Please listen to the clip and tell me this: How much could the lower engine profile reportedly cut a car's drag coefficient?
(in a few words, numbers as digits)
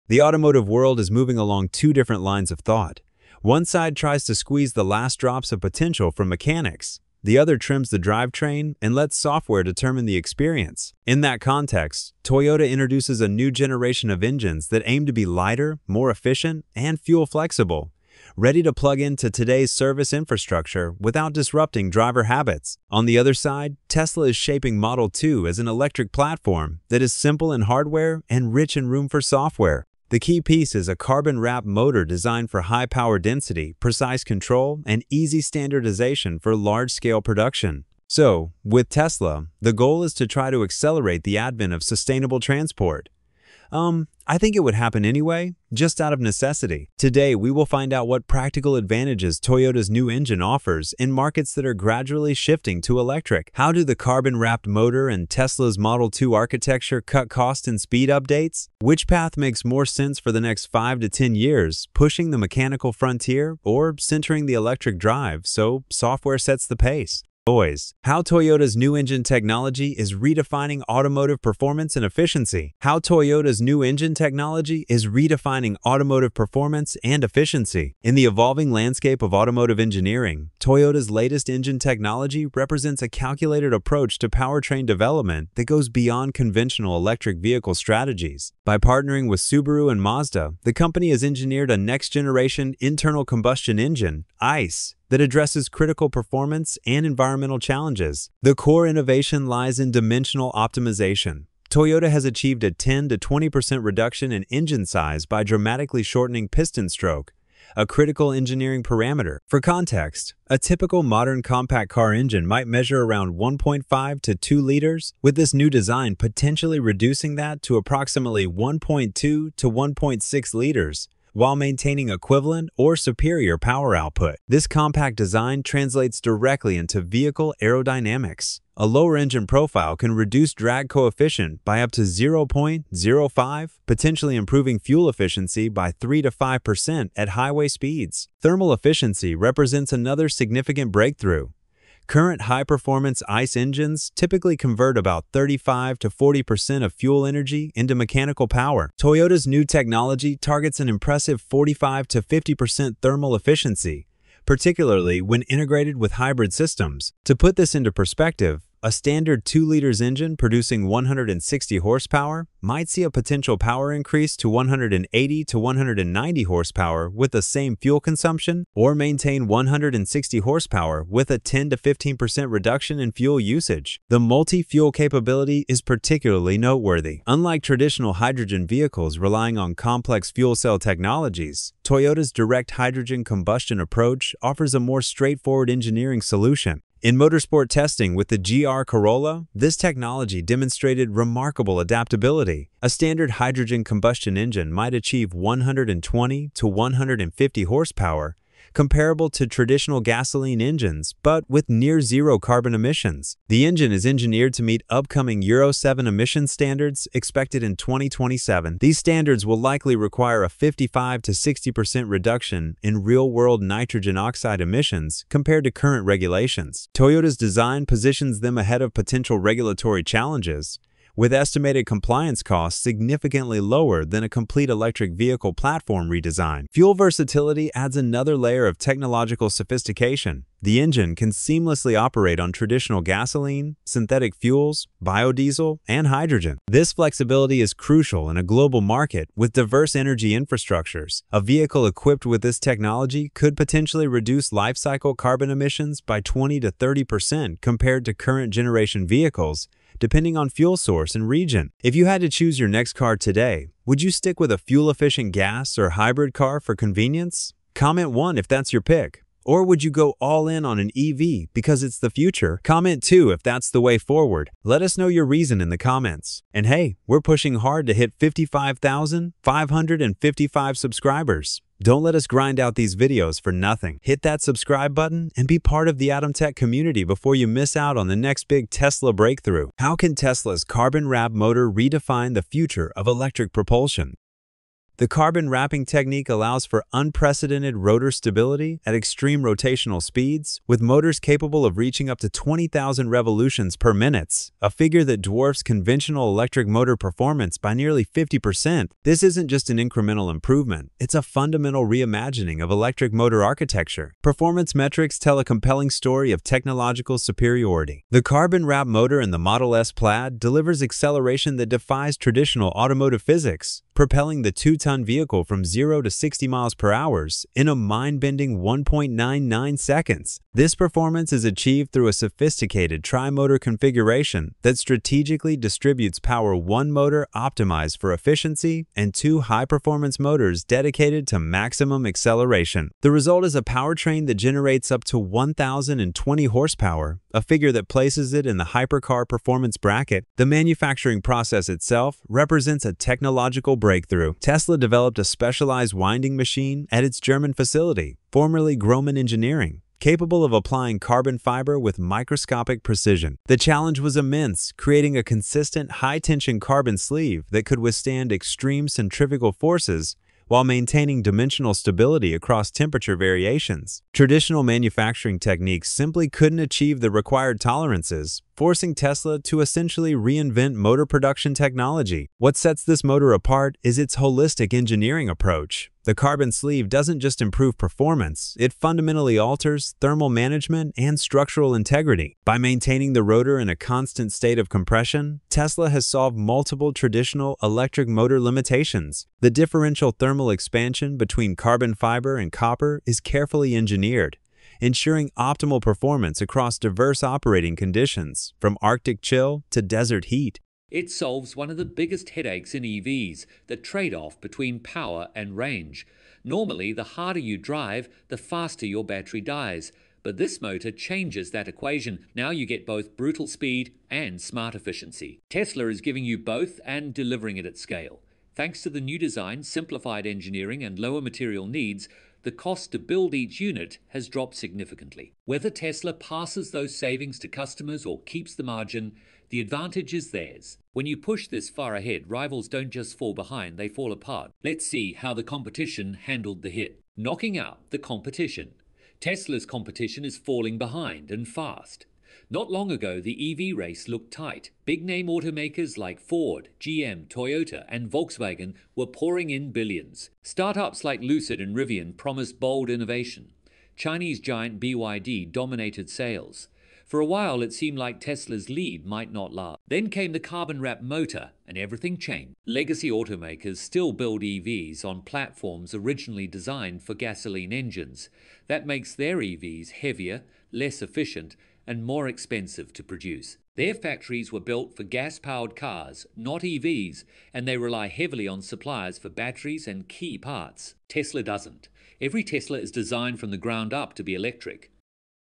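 0.05.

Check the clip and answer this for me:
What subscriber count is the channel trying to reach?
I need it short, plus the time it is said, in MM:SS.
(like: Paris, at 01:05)
55,555, at 04:28.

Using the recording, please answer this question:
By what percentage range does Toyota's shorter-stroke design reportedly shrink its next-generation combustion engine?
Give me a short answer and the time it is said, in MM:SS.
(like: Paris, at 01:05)
10 to 20%, at 01:42.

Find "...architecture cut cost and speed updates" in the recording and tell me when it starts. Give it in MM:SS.
00:56.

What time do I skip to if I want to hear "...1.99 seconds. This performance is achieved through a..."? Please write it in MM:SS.
05:18.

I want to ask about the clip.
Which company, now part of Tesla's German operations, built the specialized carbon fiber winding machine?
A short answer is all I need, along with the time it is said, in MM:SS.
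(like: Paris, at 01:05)
Grohmann Engineering, at 05:48.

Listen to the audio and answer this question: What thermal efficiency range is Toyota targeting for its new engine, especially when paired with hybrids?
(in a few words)
45 to 50%.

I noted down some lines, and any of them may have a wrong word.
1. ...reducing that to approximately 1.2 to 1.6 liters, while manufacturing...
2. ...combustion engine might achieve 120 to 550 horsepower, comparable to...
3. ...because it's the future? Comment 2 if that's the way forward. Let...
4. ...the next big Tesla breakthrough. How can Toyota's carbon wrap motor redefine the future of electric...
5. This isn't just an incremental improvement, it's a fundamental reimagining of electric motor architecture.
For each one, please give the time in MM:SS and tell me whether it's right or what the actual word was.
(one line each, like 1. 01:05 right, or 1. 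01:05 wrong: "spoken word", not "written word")
1. 01:56 wrong: "maintaining", not "manufacturing"
2. 03:13 wrong: "150", not "550"
3. 04:21 right
4. 04:38 wrong: "Tesla", not "Toyota"
5. 04:59 right.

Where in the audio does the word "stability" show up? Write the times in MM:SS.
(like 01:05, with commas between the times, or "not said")
04:48, 06:01.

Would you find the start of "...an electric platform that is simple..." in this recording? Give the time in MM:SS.
00:25.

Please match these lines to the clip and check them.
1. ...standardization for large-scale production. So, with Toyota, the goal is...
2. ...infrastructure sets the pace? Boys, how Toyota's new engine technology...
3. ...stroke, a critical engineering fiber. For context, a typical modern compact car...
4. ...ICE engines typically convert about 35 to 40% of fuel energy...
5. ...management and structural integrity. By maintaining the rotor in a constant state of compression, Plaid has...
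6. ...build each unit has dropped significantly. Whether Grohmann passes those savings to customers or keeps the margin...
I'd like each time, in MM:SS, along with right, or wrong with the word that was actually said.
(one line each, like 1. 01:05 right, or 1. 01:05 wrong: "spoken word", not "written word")
1. 00:35 wrong: "Tesla", not "Toyota"
2. 01:05 wrong: "software", not "infrastructure"
3. 01:46 wrong: "parameter", not "fiber"
4. 02:23 right
5. 06:20 wrong: "Tesla", not "Plaid"
6. 07:02 wrong: "Tesla", not "Grohmann".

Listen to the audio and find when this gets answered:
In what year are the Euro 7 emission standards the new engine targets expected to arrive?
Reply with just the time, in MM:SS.
03:27.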